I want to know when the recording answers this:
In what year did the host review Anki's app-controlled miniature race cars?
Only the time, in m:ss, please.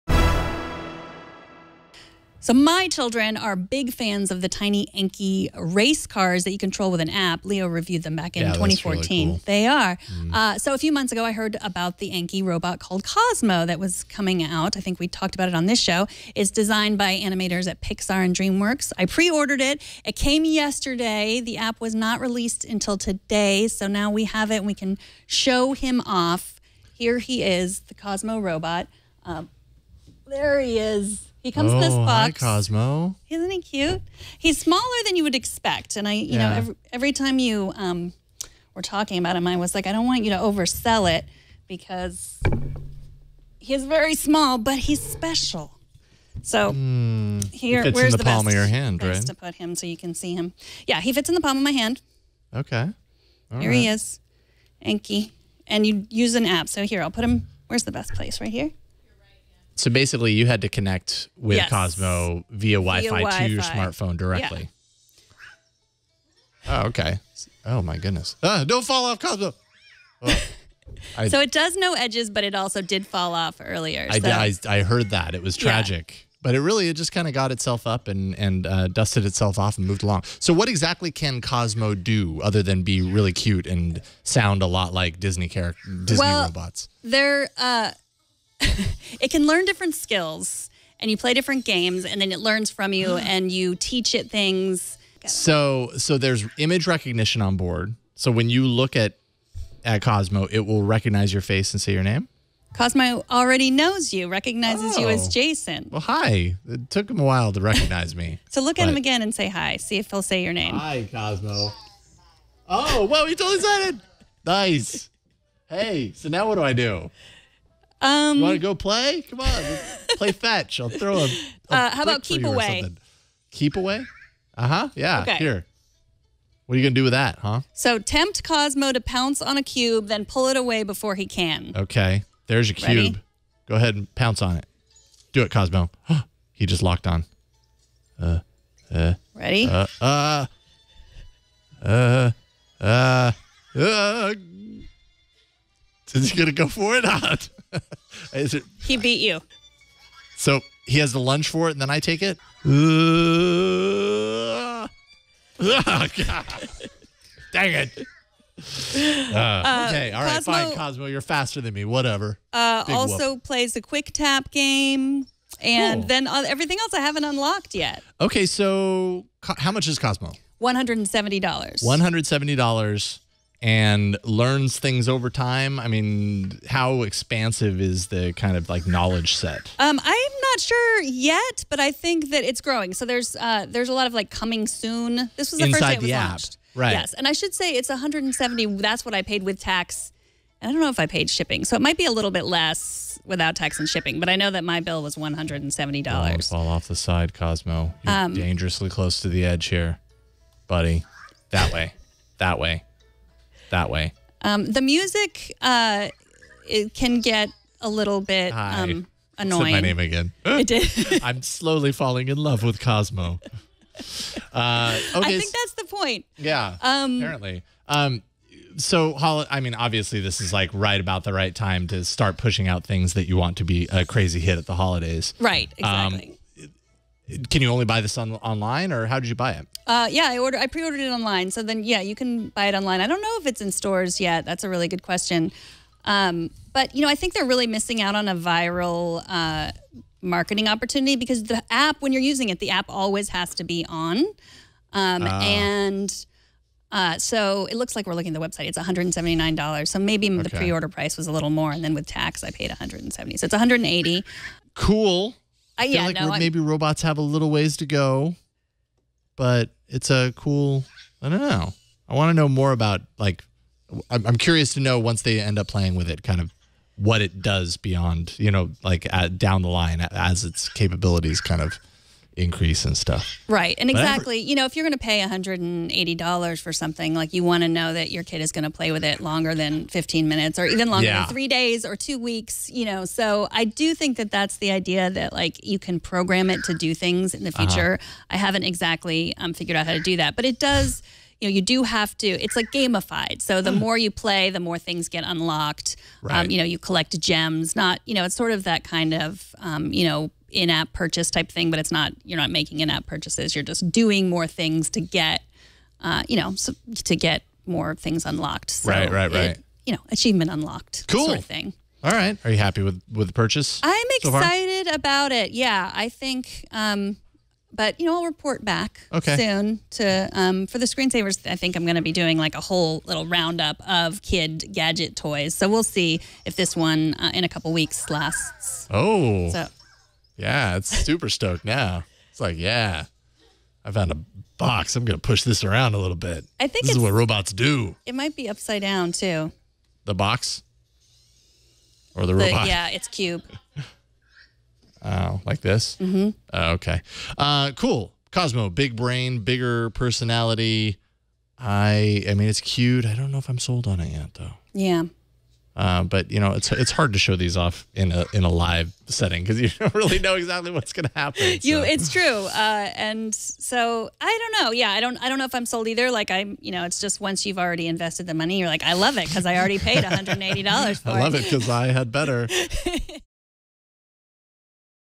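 0:08.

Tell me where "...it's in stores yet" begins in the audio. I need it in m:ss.
3:53.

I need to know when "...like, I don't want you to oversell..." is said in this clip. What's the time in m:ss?
0:39.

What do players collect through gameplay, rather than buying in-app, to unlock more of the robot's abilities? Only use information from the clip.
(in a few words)
Gems.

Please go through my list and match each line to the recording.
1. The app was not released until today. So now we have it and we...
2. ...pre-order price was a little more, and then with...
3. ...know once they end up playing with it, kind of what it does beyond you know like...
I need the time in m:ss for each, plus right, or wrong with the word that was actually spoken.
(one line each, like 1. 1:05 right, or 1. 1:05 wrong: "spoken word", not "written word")
1. 0:21 right
2. 4:10 right
3. 4:24 right.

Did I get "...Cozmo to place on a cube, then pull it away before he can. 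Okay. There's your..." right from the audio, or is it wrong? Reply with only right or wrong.
wrong.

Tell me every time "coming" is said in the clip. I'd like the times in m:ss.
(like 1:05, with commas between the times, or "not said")
0:14, 3:04.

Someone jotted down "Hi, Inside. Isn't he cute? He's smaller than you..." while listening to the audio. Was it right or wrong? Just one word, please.
wrong.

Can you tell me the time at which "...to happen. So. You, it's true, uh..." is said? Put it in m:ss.
6:01.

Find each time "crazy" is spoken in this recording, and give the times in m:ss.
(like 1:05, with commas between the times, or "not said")
3:44.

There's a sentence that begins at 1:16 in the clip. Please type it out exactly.
but it really it just kind of got itself up and and uh, dusted itself off and moved along.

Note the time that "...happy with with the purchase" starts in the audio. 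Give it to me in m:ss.
5:12.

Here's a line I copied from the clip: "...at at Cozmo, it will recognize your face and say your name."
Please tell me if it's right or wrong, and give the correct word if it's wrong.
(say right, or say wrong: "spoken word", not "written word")
right.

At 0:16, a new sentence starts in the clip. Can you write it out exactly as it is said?
It's designed by animators at Pixar and DreamWorks.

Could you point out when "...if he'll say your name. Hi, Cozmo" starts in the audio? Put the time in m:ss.
1:49.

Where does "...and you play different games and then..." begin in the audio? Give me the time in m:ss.
1:30.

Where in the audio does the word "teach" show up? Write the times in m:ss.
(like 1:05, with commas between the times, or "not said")
1:33.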